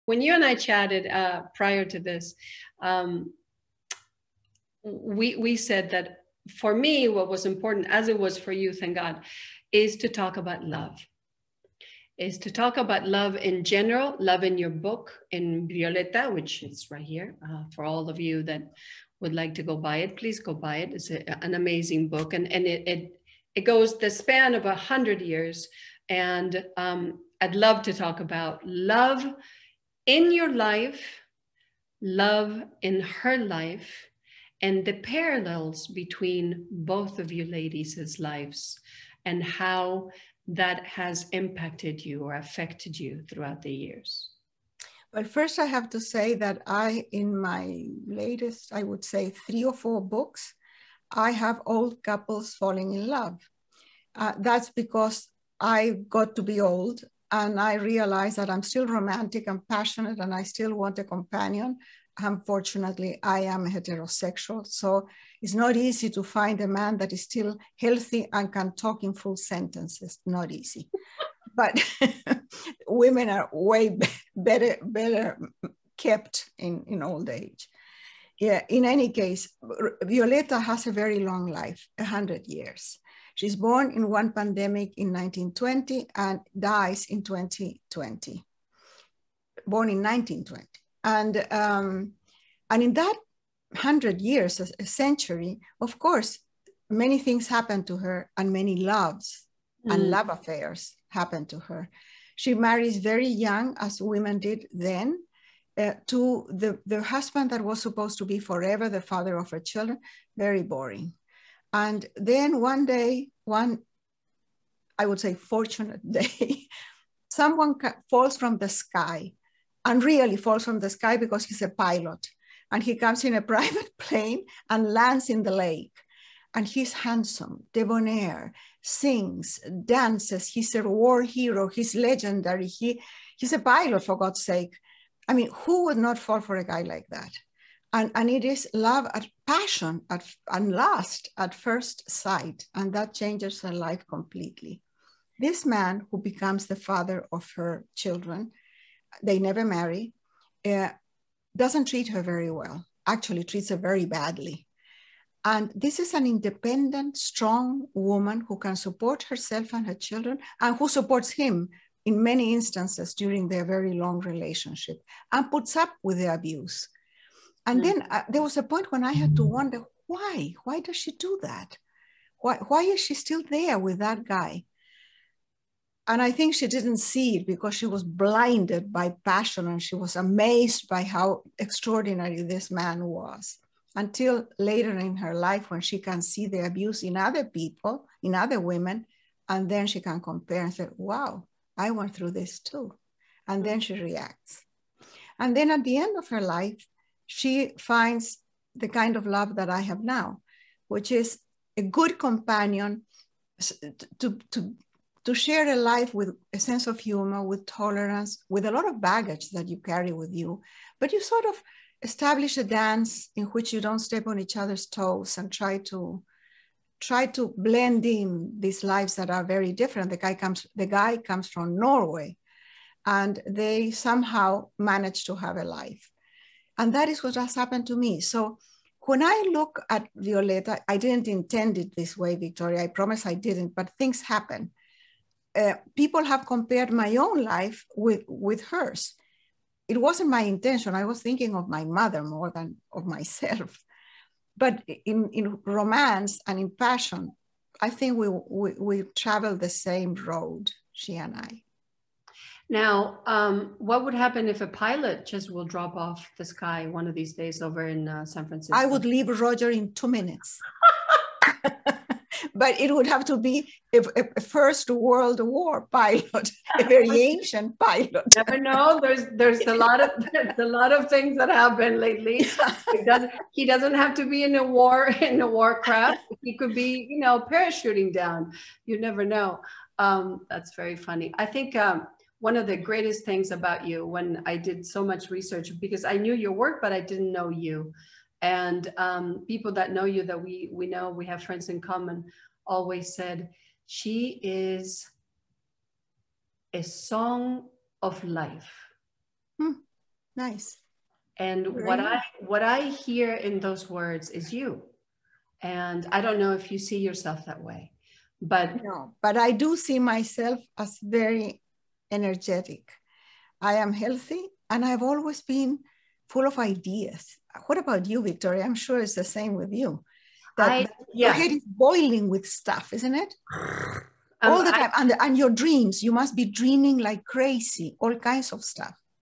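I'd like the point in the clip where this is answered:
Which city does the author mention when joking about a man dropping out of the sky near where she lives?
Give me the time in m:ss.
4:18.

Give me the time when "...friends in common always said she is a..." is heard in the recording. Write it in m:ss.
4:51.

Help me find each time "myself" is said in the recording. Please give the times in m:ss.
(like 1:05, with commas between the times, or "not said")
4:03, 5:09.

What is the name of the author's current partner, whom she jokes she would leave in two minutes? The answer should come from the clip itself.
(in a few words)
Roger.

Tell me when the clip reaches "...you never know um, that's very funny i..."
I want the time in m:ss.
4:38.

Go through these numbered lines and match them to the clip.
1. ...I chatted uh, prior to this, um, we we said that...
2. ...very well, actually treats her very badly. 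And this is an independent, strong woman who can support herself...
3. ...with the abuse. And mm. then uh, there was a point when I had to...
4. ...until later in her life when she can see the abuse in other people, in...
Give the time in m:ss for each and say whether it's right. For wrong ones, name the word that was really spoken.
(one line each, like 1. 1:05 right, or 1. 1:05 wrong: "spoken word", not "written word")
1. 0:00 right
2. 2:32 right
3. 2:46 right
4. 3:03 right.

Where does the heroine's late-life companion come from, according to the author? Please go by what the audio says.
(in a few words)
Norway.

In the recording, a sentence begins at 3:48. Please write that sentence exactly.
So when I look at Violeta, I didn't intend it this way, Victoria.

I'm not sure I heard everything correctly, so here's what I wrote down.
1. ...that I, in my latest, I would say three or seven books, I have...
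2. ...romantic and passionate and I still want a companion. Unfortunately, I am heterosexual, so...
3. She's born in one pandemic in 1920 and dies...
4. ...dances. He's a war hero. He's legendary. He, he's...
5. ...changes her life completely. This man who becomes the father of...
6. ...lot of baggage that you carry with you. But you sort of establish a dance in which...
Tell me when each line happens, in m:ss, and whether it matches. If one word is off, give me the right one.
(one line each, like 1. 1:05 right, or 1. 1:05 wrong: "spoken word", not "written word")
1. 0:46 wrong: "four", not "seven"
2. 0:58 right
3. 1:23 right
4. 2:09 right
5. 2:23 right
6. 3:28 right.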